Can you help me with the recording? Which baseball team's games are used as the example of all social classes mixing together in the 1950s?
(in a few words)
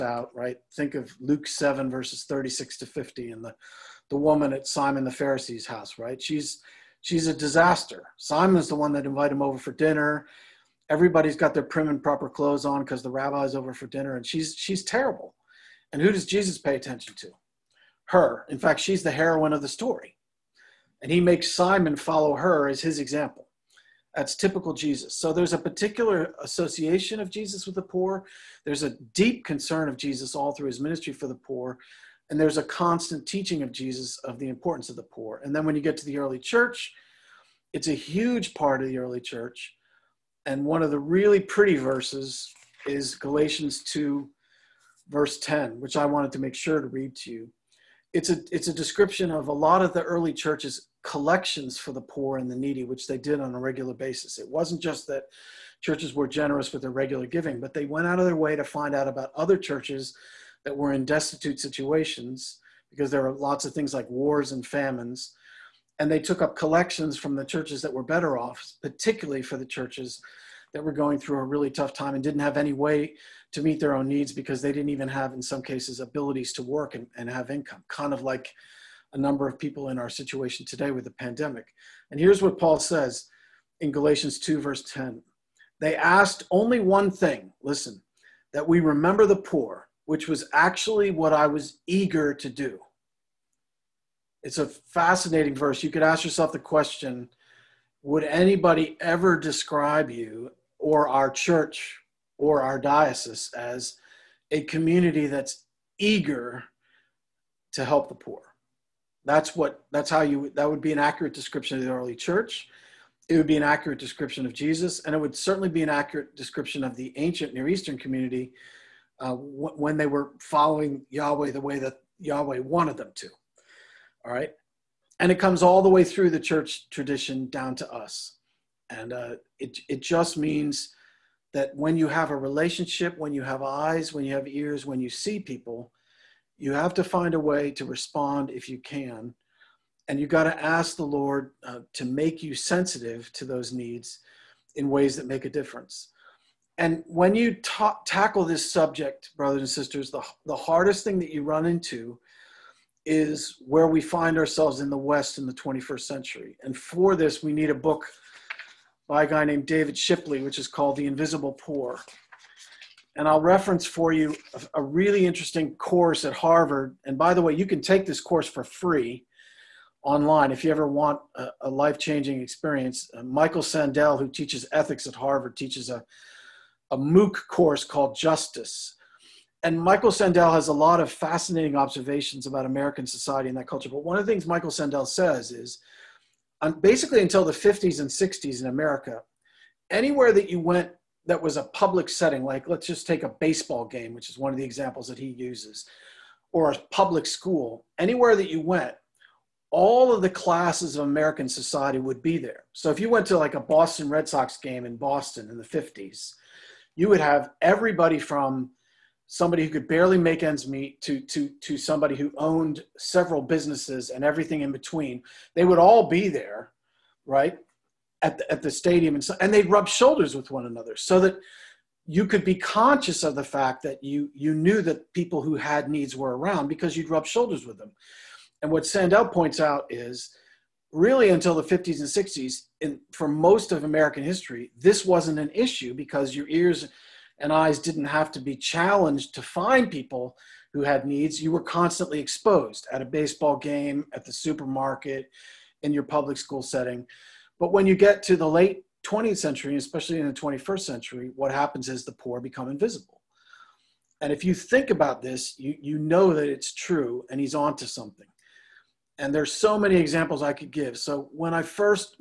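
Boston Red Sox.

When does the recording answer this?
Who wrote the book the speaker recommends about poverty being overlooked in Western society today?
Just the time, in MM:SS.
02:39.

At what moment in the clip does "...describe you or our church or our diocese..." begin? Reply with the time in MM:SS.
01:39.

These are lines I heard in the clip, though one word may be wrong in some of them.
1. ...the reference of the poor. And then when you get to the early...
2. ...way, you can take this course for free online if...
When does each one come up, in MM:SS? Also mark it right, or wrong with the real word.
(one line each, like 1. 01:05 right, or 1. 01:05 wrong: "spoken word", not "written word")
1. 00:34 wrong: "importance", not "reference"
2. 02:47 right.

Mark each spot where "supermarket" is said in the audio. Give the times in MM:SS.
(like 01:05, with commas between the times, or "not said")
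04:04.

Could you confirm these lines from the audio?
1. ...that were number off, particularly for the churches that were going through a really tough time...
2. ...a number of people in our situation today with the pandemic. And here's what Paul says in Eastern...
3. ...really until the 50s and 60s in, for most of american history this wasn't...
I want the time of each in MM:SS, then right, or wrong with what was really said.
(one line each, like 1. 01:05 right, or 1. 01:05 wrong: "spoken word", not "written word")
1. 01:07 wrong: "better", not "number"
2. 01:19 wrong: "Galatians", not "Eastern"
3. 03:50 right.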